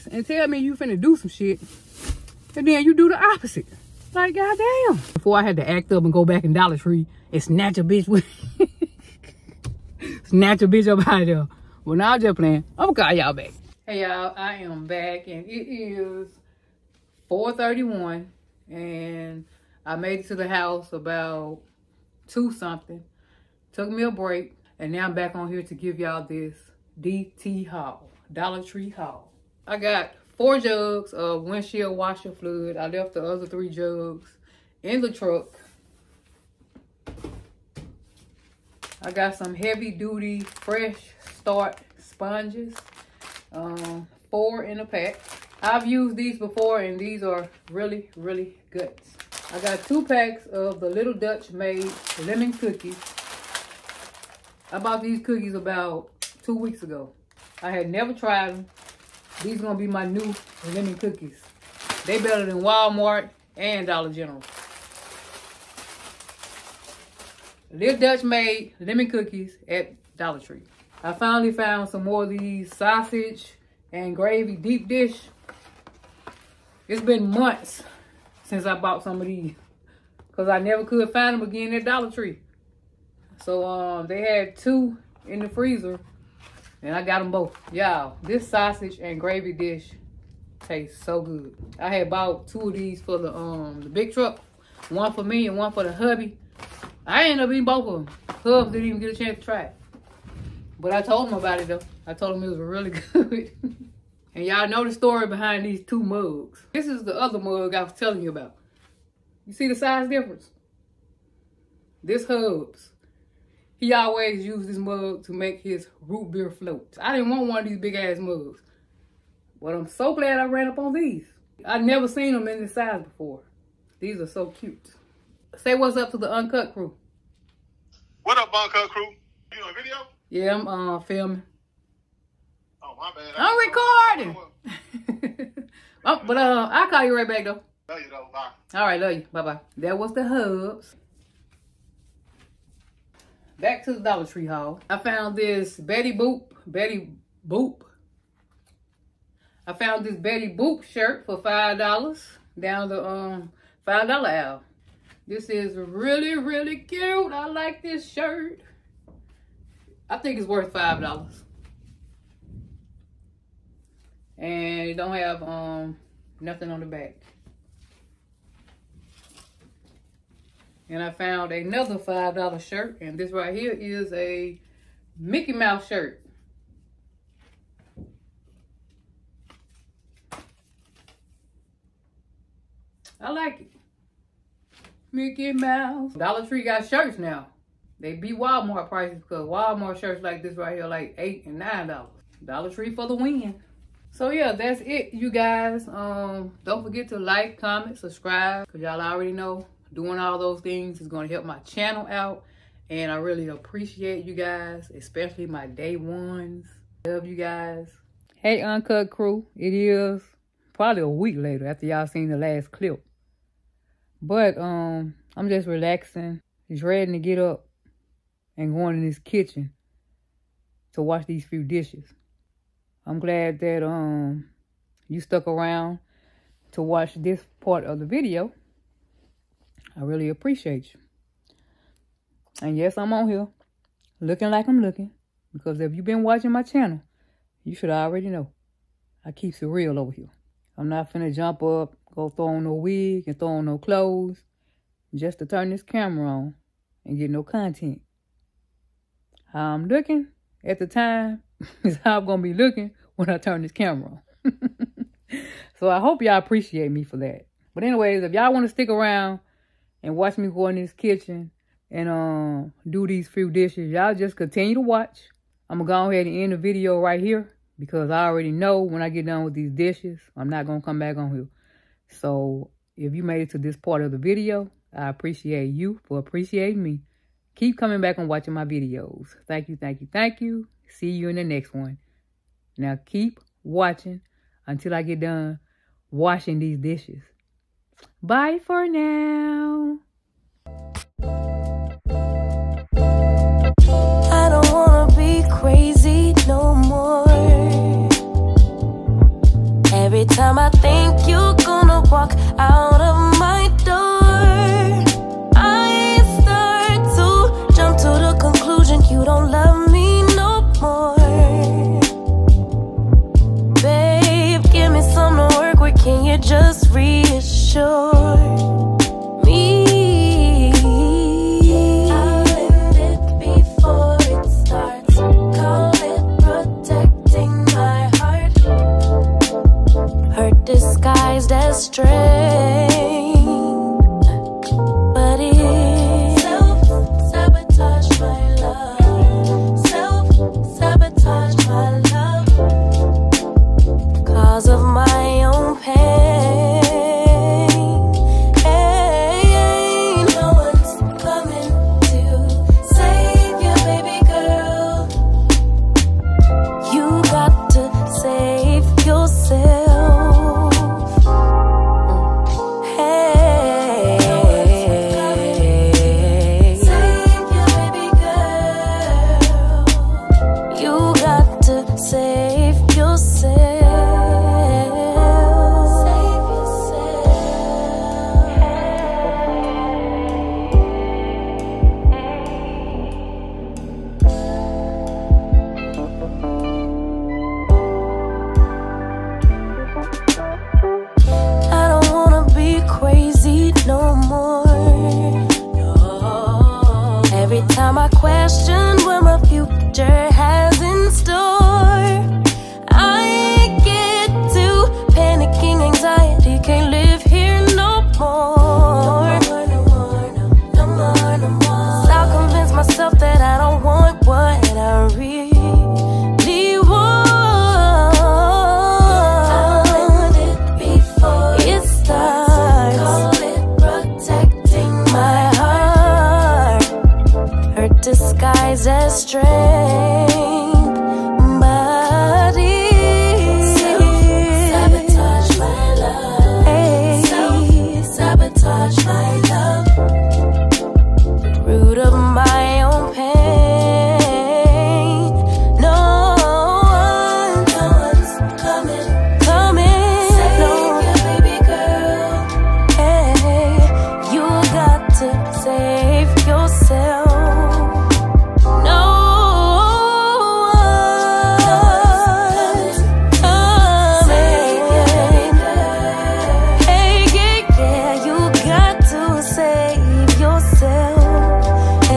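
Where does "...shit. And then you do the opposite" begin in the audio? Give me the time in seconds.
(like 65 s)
1 s.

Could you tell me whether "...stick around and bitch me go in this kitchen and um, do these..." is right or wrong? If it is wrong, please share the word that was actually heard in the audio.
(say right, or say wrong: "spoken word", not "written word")
wrong: "watch", not "bitch".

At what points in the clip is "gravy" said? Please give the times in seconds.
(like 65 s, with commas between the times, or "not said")
74 s, 89 s.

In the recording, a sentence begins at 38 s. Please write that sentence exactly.
I got some heavy duty fresh start sponges um, four in a pack.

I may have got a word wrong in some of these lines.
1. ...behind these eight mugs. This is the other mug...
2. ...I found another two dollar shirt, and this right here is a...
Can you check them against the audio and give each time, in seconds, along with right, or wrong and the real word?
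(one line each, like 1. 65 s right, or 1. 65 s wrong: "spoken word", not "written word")
1. 105 s wrong: "two", not "eight"
2. 171 s wrong: "five", not "two".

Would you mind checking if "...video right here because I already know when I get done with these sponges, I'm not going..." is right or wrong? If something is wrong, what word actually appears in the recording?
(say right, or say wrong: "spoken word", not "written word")
wrong: "dishes", not "sponges".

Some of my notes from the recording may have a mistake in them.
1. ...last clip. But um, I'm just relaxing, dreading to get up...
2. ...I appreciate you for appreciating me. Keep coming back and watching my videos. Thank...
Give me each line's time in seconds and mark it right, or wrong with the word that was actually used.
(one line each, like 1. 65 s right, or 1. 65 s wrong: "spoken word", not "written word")
1. 212 s right
2. 274 s right.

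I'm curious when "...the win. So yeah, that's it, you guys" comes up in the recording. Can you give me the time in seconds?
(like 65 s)
193 s.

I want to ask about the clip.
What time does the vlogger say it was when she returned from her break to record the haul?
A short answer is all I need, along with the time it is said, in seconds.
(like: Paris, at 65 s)
4:31, at 17 s.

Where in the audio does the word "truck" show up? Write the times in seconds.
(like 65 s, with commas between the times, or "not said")
35 s, 94 s.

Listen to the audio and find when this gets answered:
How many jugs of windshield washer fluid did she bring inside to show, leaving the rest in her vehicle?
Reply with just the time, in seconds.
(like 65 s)
30 s.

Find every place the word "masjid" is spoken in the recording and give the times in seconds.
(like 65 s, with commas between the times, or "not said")
not said.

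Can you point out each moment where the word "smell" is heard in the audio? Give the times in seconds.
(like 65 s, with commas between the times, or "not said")
not said.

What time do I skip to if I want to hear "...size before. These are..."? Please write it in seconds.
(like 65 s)
122 s.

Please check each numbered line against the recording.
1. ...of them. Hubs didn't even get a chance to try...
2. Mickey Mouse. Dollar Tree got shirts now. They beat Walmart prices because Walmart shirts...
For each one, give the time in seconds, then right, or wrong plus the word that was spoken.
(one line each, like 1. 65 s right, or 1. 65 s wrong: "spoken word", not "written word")
1. 97 s right
2. 185 s right.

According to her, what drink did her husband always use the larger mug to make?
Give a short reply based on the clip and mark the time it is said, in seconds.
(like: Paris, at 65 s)
Root beer floats, at 116 s.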